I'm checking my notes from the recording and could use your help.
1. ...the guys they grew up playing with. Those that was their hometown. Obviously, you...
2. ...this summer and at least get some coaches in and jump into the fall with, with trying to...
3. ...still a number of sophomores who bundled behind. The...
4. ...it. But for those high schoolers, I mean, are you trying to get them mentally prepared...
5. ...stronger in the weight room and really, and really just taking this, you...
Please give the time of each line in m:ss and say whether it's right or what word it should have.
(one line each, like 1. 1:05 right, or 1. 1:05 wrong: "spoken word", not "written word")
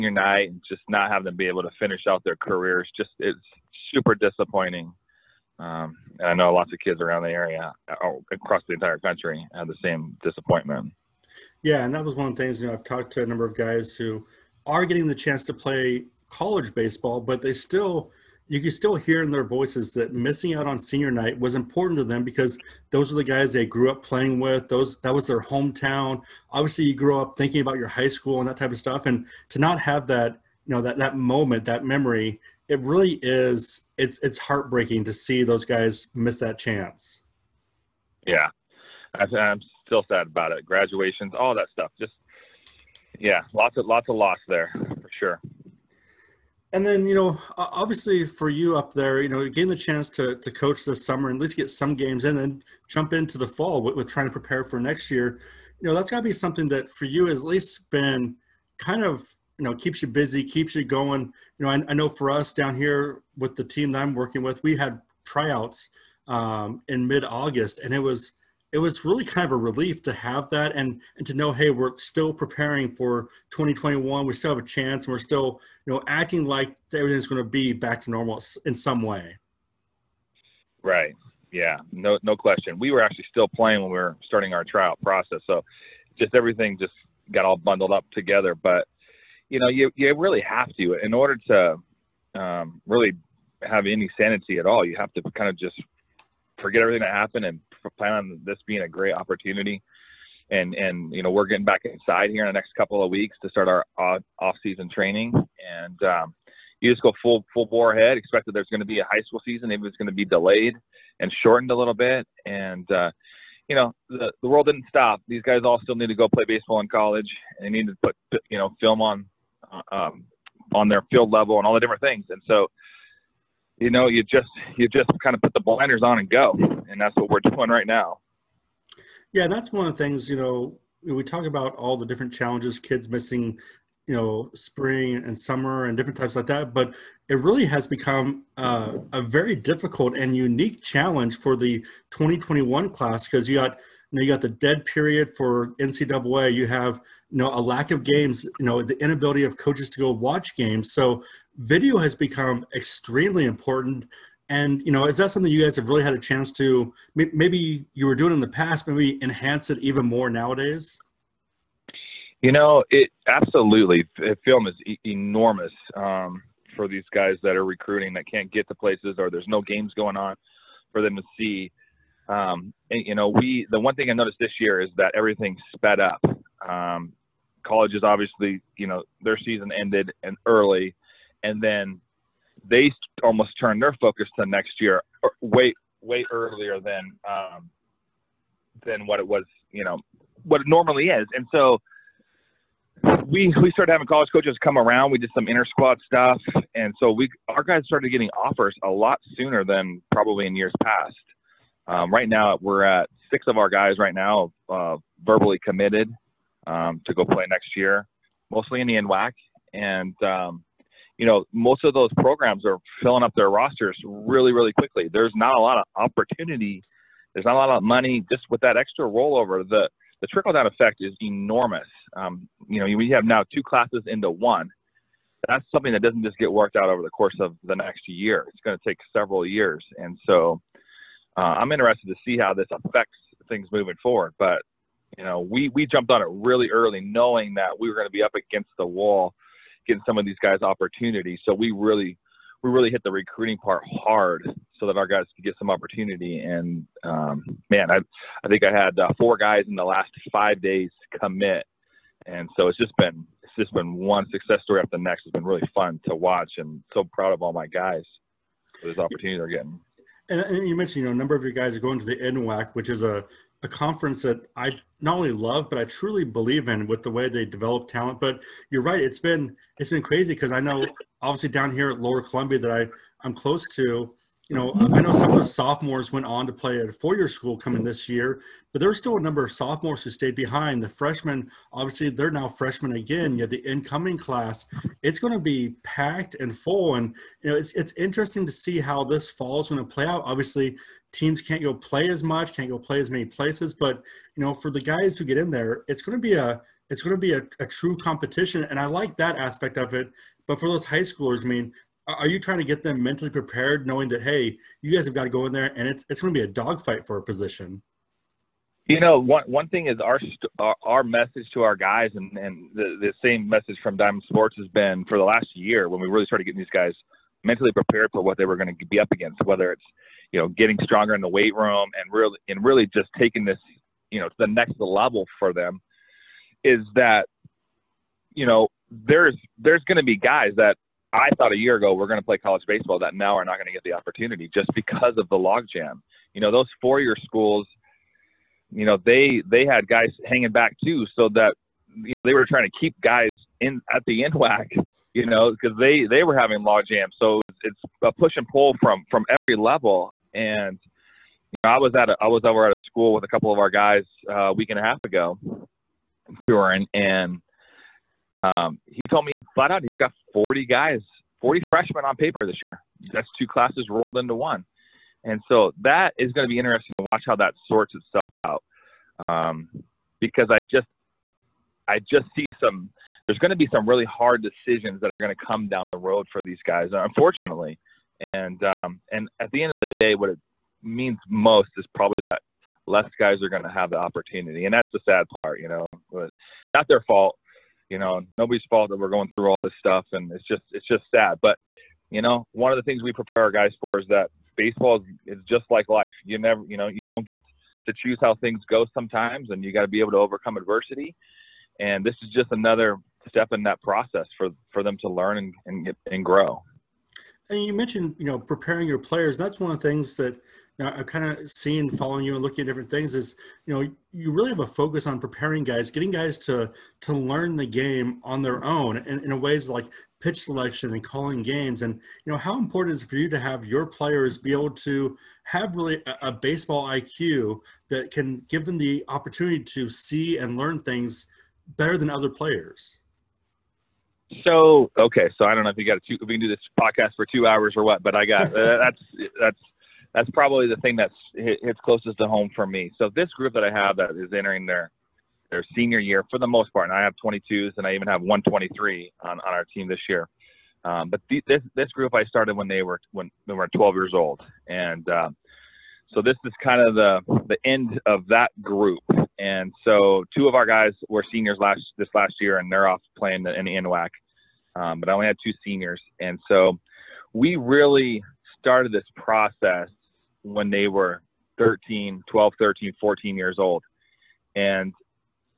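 1. 0:23 right
2. 0:50 wrong: "games", not "coaches"
3. 4:38 wrong: "stayed", not "bundled"
4. 4:59 right
5. 5:20 right.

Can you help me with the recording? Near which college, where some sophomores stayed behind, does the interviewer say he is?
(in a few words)
Lower Columbia.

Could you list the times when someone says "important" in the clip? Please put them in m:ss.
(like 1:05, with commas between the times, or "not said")
0:21, 2:33, 7:02.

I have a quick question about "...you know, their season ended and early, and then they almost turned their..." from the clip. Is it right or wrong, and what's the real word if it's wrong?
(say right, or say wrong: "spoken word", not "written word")
right.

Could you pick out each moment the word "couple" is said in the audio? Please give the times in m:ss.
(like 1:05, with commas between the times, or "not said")
1:42, 5:53.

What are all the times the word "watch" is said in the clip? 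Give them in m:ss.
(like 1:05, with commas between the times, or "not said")
2:30, 4:16, 6:07.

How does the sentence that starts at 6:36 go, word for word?
You never, you know, you don't get to choose how things go sometimes, and you got to be able to overcome adversity.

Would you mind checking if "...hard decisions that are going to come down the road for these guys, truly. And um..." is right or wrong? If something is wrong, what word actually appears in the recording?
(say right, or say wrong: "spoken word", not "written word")
wrong: "unfortunately", not "truly".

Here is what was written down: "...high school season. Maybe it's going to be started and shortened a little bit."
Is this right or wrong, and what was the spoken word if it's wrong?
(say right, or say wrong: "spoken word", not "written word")
wrong: "delayed", not "started".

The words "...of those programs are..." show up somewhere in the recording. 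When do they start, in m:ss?
3:31.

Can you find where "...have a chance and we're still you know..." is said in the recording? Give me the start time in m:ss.
1:14.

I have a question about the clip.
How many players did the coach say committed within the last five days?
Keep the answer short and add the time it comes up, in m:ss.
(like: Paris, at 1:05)
4, at 4:09.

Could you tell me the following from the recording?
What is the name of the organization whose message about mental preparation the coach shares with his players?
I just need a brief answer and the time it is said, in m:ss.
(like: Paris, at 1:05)
Diamond Sports, at 5:13.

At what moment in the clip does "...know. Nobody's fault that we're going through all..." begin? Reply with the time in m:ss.
6:27.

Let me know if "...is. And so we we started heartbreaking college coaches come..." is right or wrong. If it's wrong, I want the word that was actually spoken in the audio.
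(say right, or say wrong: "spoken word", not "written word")
wrong: "having", not "heartbreaking".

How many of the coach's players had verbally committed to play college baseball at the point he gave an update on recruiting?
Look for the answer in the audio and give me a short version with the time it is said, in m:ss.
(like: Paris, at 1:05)
6, at 3:23.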